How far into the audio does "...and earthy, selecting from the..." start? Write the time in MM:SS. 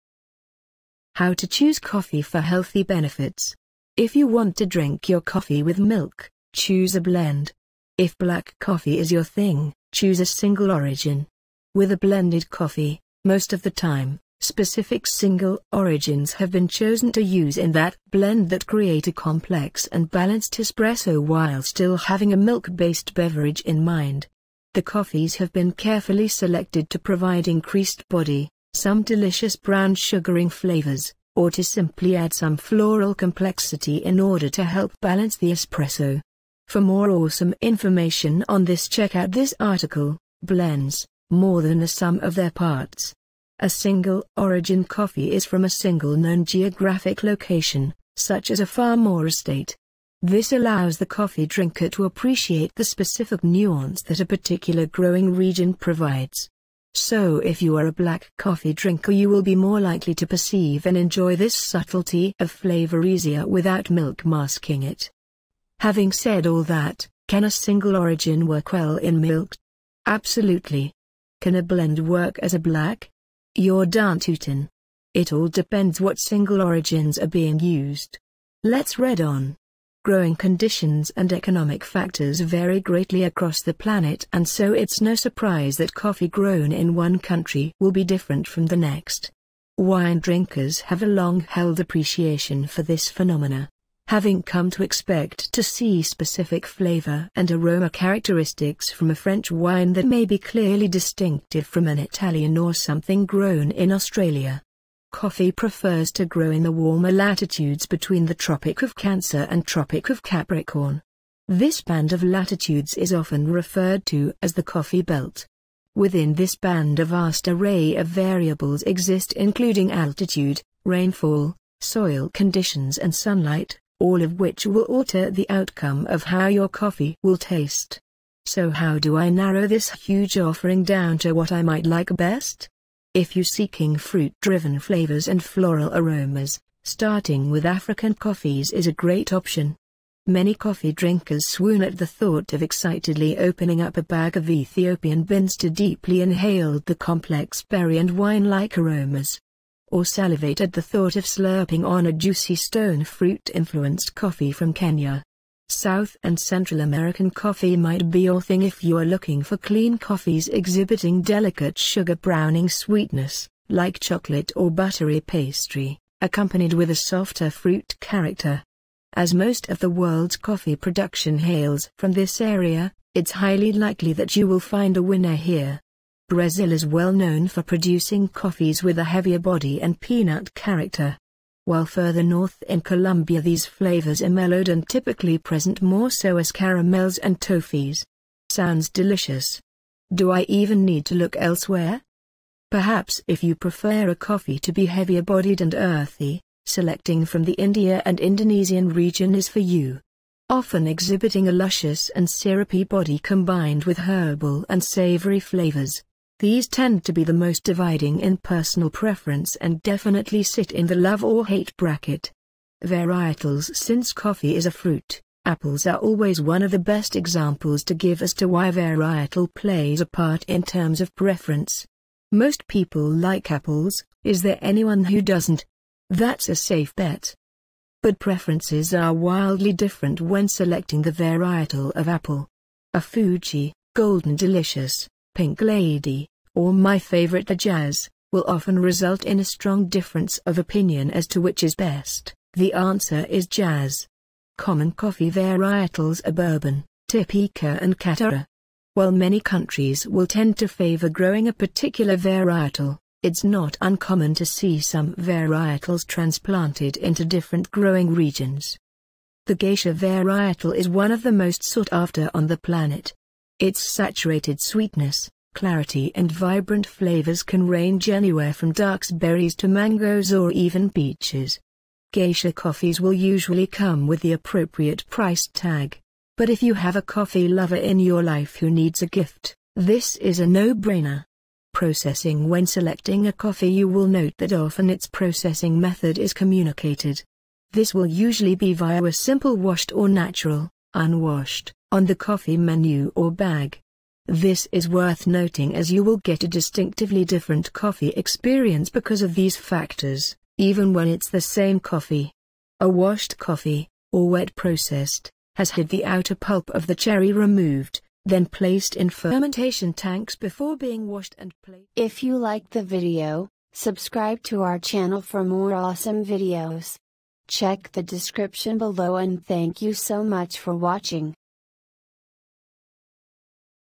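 03:15.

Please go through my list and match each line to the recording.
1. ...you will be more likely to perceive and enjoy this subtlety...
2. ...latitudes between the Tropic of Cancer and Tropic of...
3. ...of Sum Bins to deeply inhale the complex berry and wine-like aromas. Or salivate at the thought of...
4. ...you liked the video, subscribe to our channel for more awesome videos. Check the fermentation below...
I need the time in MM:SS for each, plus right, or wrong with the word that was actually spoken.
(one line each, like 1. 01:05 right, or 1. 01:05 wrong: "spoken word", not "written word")
1. 00:59 right
2. 01:47 right
3. 02:24 wrong: "Ethiopian", not "Sum"
4. 05:12 wrong: "description", not "fermentation".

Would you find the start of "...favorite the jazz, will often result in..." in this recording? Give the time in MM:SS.
03:56.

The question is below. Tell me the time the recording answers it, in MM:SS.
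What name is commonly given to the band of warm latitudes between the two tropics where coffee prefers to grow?
01:54.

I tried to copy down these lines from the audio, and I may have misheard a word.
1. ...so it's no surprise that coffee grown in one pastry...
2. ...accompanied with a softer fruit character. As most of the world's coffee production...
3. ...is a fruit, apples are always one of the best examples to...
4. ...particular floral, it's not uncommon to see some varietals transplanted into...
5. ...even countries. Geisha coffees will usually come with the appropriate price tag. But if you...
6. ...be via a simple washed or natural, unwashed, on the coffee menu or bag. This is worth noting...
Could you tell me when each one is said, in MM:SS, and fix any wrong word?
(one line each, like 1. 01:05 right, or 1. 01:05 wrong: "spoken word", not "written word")
1. 01:24 wrong: "country", not "pastry"
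2. 02:46 right
3. 03:34 right
4. 04:11 wrong: "varietal", not "floral"
5. 04:30 wrong: "peaches", not "countries"
6. 04:48 right.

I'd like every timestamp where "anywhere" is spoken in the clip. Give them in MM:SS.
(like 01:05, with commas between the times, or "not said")
04:28.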